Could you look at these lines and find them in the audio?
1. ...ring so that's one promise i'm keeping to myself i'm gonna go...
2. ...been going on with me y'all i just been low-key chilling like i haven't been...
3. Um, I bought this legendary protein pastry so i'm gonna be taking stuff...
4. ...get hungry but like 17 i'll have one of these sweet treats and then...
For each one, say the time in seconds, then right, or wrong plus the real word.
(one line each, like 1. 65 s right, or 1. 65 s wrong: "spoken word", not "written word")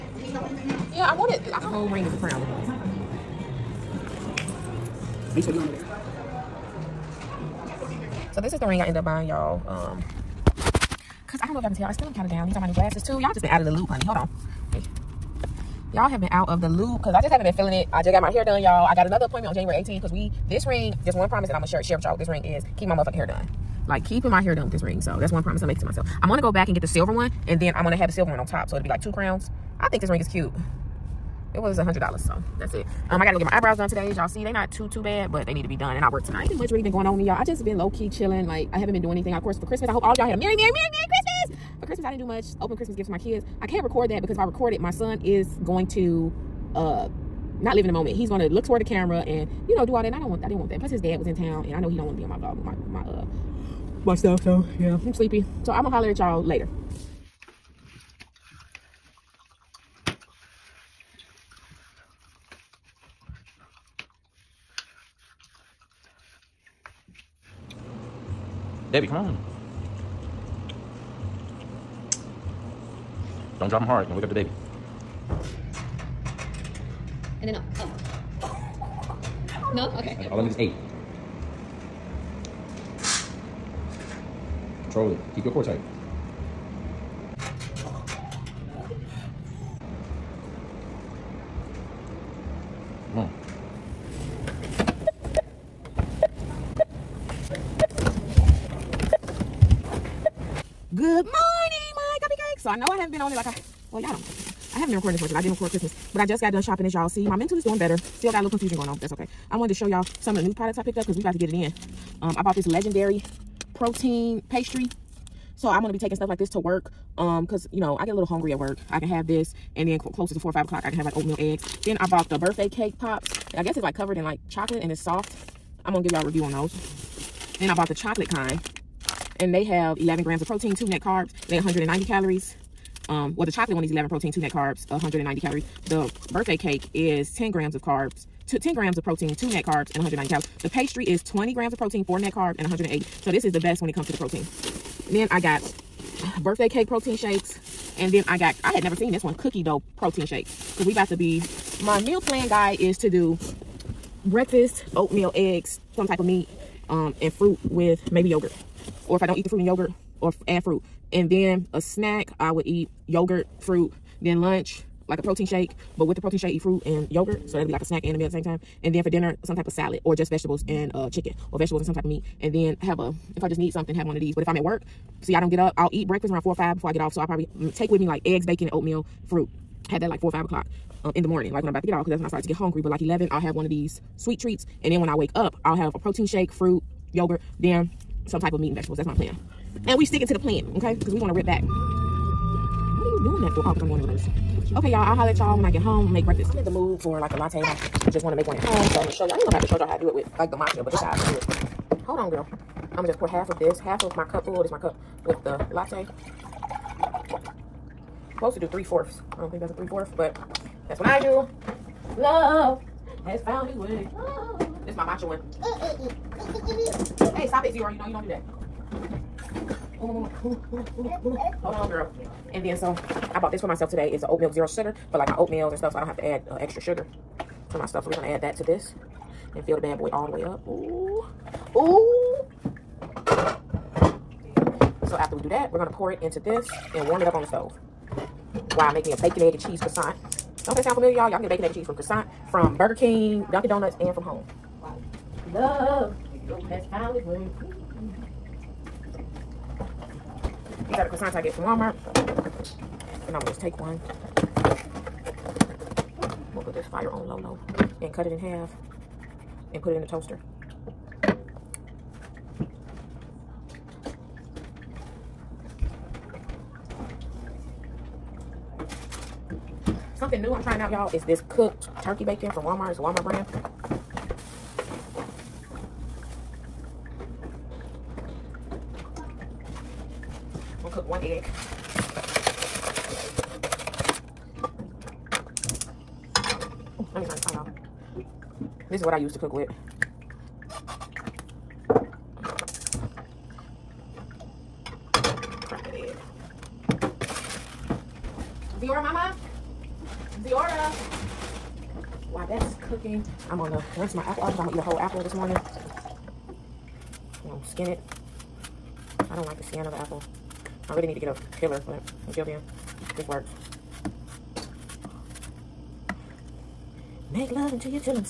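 1. 24 s wrong: "making", not "keeping"
2. 36 s right
3. 112 s right
4. 182 s wrong: "11", not "17".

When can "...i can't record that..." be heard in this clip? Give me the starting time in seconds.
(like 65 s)
43 s.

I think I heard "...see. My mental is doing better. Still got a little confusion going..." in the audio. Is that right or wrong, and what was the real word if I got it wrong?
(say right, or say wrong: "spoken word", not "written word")
right.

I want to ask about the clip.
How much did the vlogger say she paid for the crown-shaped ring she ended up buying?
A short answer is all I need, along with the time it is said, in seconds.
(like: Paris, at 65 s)
$100, at 31 s.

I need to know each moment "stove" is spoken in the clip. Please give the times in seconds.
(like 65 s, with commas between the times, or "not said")
237 s.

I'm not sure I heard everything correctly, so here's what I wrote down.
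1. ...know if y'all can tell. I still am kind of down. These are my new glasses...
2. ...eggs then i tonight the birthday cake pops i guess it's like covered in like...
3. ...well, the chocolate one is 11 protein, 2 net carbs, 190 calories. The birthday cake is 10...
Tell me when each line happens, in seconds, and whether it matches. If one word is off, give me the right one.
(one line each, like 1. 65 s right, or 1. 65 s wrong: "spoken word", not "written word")
1. 11 s right
2. 121 s wrong: "bought", not "tonight"
3. 133 s right.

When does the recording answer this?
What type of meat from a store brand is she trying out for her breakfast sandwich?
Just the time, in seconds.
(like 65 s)
272 s.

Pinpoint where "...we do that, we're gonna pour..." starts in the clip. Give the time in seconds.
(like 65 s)
235 s.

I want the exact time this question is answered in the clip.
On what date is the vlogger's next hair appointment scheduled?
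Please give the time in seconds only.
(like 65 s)
19 s.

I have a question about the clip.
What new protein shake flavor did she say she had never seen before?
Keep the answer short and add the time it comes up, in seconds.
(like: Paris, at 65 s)
Cookie dough, at 149 s.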